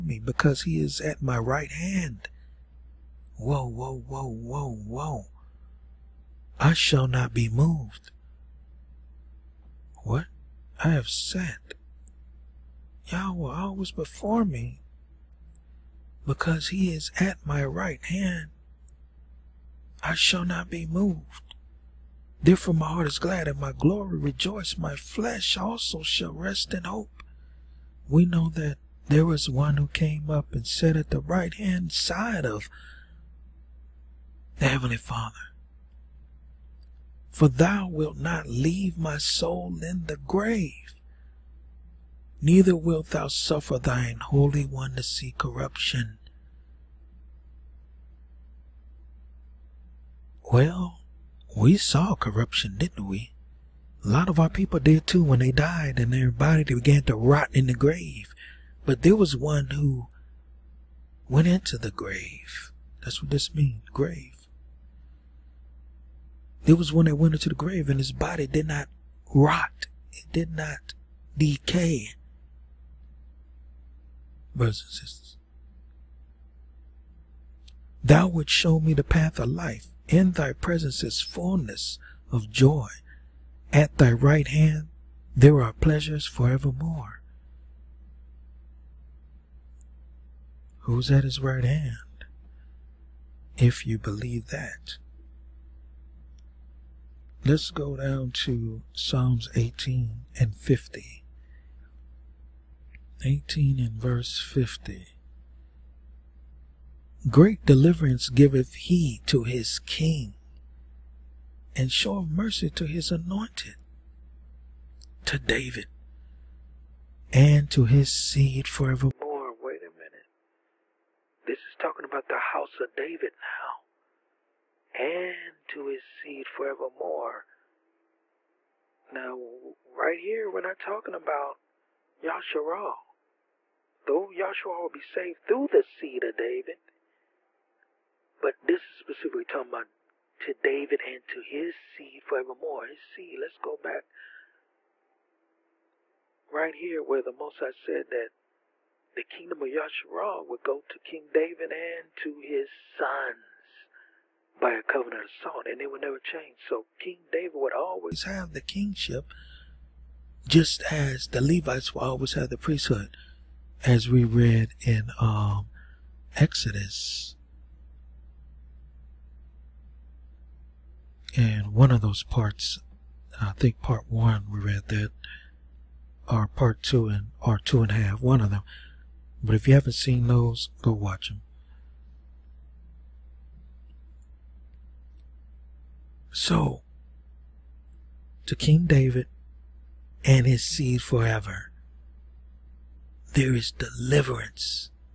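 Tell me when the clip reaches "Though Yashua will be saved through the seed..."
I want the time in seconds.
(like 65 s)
134 s.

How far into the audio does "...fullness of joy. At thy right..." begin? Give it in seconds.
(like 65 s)
81 s.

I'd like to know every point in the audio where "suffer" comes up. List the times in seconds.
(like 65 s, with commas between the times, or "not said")
43 s.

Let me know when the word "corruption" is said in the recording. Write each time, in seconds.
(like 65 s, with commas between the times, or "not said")
45 s, 52 s.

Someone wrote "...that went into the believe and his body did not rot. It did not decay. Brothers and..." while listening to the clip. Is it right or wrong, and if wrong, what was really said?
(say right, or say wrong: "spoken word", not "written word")
wrong: "grave", not "believe".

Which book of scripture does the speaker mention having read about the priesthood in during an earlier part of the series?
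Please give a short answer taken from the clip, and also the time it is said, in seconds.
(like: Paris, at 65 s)
Exodus, at 166 s.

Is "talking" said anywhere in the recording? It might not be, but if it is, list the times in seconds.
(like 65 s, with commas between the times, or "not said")
121 s, 130 s, 139 s.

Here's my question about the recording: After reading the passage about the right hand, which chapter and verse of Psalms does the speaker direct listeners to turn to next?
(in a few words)
Psalms 18:50.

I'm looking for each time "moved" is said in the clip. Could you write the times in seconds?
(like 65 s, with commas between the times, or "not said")
7 s, 20 s.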